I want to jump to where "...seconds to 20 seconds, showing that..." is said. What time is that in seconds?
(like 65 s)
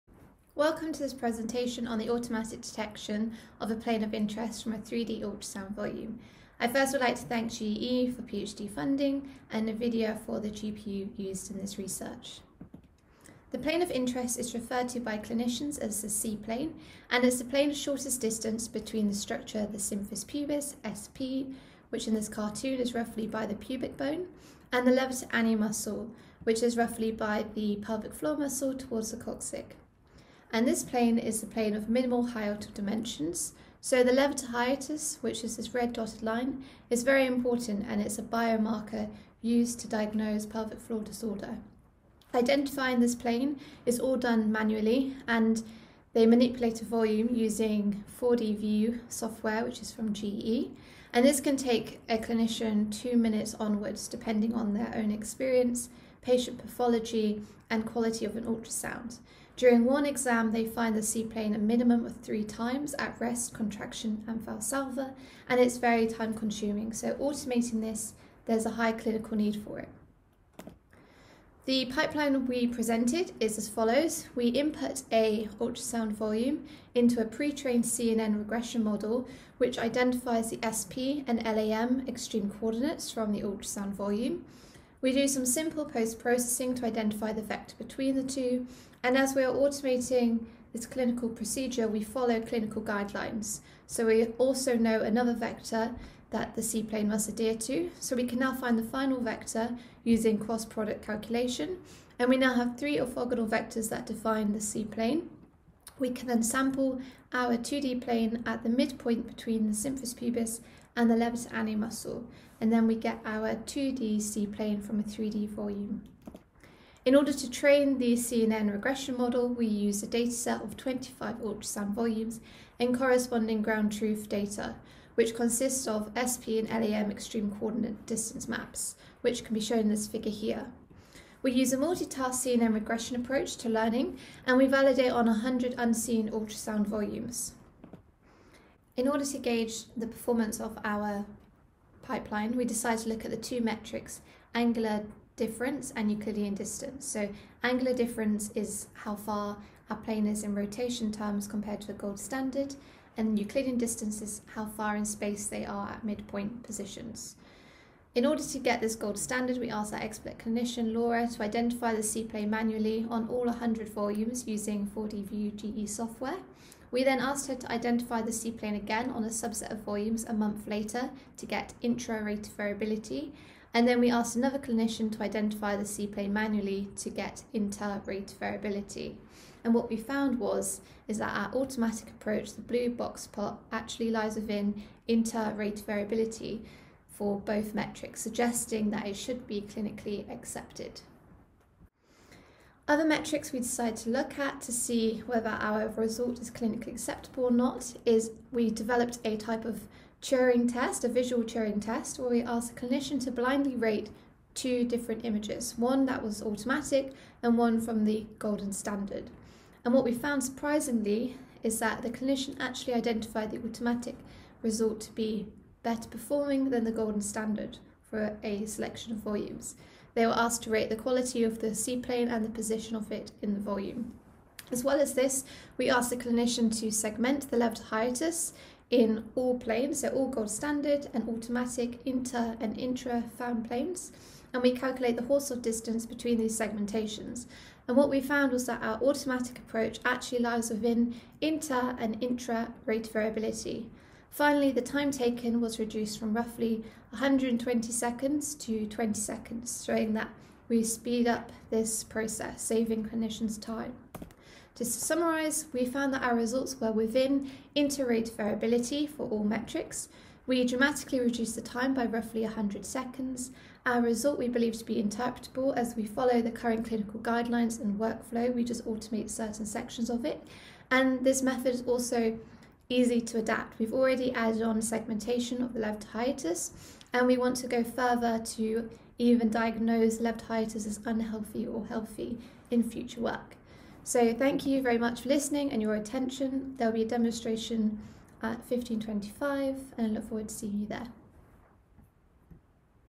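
247 s.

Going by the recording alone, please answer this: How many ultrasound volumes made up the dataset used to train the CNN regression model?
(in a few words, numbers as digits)
25.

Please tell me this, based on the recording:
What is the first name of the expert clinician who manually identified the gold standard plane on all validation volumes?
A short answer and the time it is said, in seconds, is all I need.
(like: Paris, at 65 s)
Laura, at 160 s.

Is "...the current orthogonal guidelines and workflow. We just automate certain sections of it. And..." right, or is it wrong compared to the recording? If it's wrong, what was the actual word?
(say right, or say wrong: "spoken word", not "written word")
wrong: "clinical", not "orthogonal".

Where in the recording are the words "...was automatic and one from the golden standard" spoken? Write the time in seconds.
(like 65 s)
206 s.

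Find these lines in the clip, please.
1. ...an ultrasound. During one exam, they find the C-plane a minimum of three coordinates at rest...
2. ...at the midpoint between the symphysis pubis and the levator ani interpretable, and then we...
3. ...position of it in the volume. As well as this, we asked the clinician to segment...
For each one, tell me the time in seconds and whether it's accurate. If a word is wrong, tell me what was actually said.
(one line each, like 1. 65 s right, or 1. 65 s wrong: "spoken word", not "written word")
1. 58 s wrong: "times", not "coordinates"
2. 108 s wrong: "muscle", not "interpretable"
3. 222 s right.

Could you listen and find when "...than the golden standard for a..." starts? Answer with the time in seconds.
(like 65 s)
216 s.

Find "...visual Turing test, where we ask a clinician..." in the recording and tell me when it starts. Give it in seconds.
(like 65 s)
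201 s.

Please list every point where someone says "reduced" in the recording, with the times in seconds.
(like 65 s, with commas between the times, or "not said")
245 s, 261 s.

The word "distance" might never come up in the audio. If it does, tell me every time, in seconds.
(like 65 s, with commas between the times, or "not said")
18 s, 128 s, 146 s, 153 s, 235 s.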